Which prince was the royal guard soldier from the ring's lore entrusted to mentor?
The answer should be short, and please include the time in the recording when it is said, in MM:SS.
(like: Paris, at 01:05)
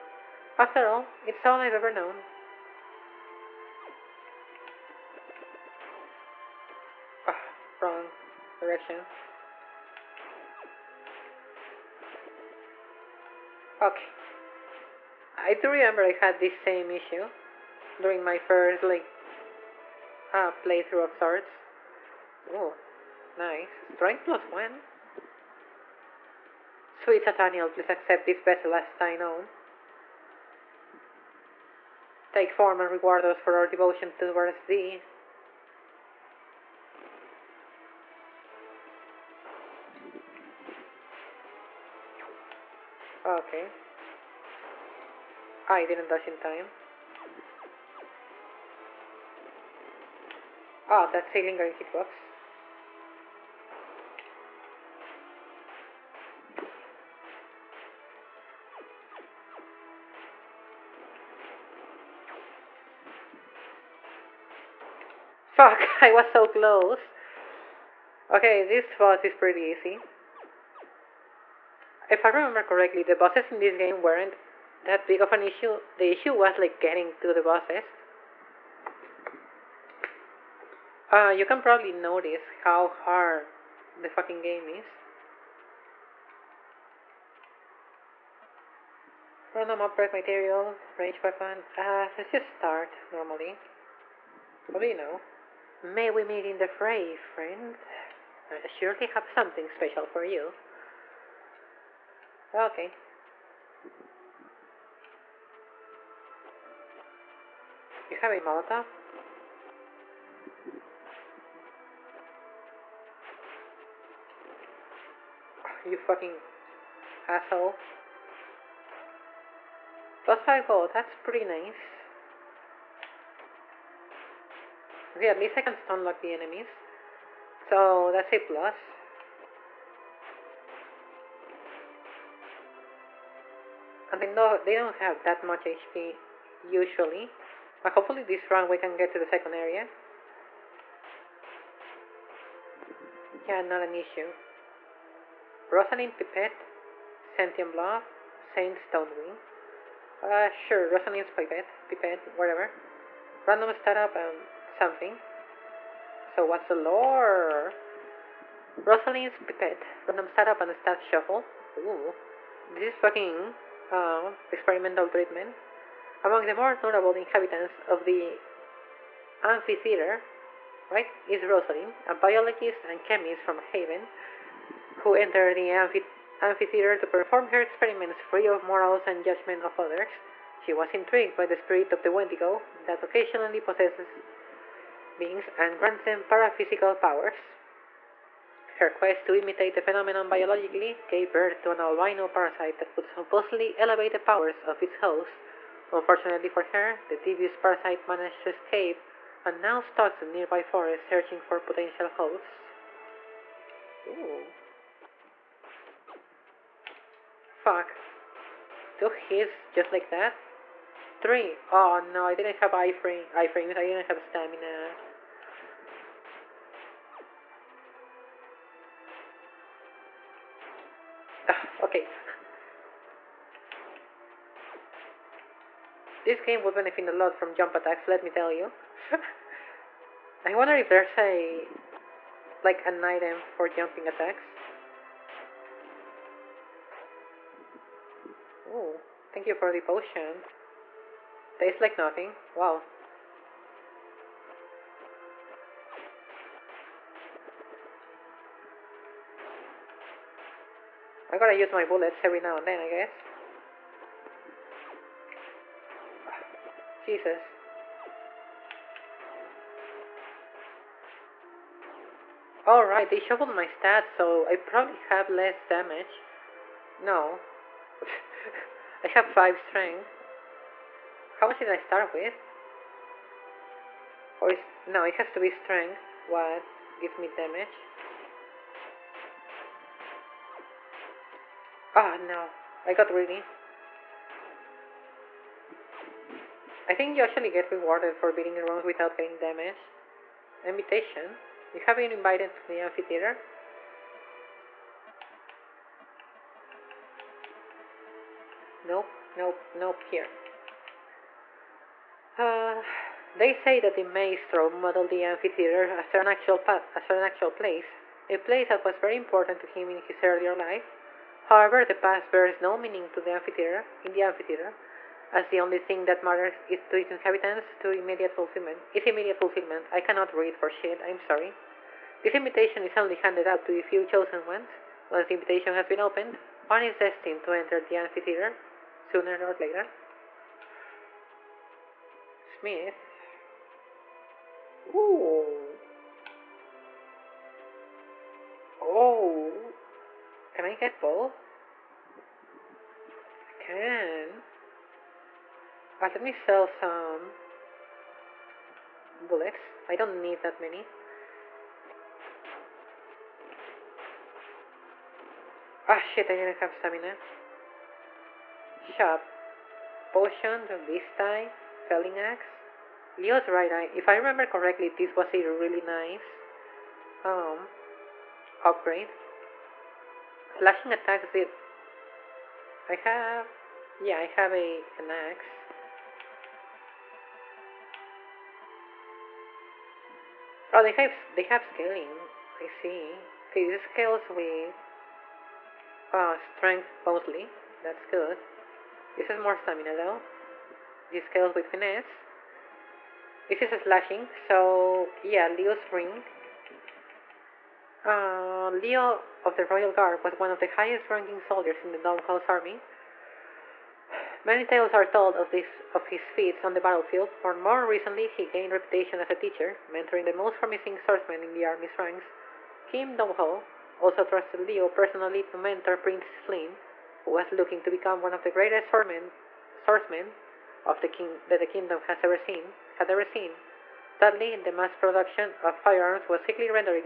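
Prince Flynn, at 06:55.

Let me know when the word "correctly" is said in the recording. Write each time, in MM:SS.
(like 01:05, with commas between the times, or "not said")
01:12, 06:04.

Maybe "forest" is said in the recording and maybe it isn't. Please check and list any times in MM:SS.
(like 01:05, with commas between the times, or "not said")
03:20.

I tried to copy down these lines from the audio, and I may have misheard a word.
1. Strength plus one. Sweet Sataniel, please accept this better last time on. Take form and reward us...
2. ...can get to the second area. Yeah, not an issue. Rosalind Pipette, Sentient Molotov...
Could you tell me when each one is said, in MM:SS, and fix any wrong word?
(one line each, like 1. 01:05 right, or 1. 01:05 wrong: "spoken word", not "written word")
1. 00:23 right
2. 02:18 wrong: "Blob", not "Molotov".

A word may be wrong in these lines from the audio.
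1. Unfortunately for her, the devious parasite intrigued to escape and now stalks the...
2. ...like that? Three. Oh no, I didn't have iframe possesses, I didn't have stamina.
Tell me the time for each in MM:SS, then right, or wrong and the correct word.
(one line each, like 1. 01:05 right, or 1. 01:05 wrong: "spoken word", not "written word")
1. 03:15 wrong: "managed", not "intrigued"
2. 03:29 wrong: "iframes", not "possesses".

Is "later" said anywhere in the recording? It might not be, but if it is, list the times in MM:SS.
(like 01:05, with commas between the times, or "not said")
05:29.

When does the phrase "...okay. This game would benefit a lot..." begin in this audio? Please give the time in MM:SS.
03:41.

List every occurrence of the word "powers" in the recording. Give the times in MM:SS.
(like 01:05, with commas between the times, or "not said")
03:06, 03:14.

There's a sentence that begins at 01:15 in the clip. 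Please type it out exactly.
The issue was like getting to the bosses.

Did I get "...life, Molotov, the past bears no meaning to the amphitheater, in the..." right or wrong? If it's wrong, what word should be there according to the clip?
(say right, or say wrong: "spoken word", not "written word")
wrong: "However", not "Molotov".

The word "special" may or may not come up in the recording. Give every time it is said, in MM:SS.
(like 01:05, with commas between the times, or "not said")
01:39.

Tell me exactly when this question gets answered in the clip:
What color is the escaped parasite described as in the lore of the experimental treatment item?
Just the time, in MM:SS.
03:11.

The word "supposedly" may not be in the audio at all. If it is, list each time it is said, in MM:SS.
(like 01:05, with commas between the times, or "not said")
03:13.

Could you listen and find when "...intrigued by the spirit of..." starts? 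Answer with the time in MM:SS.
03:00.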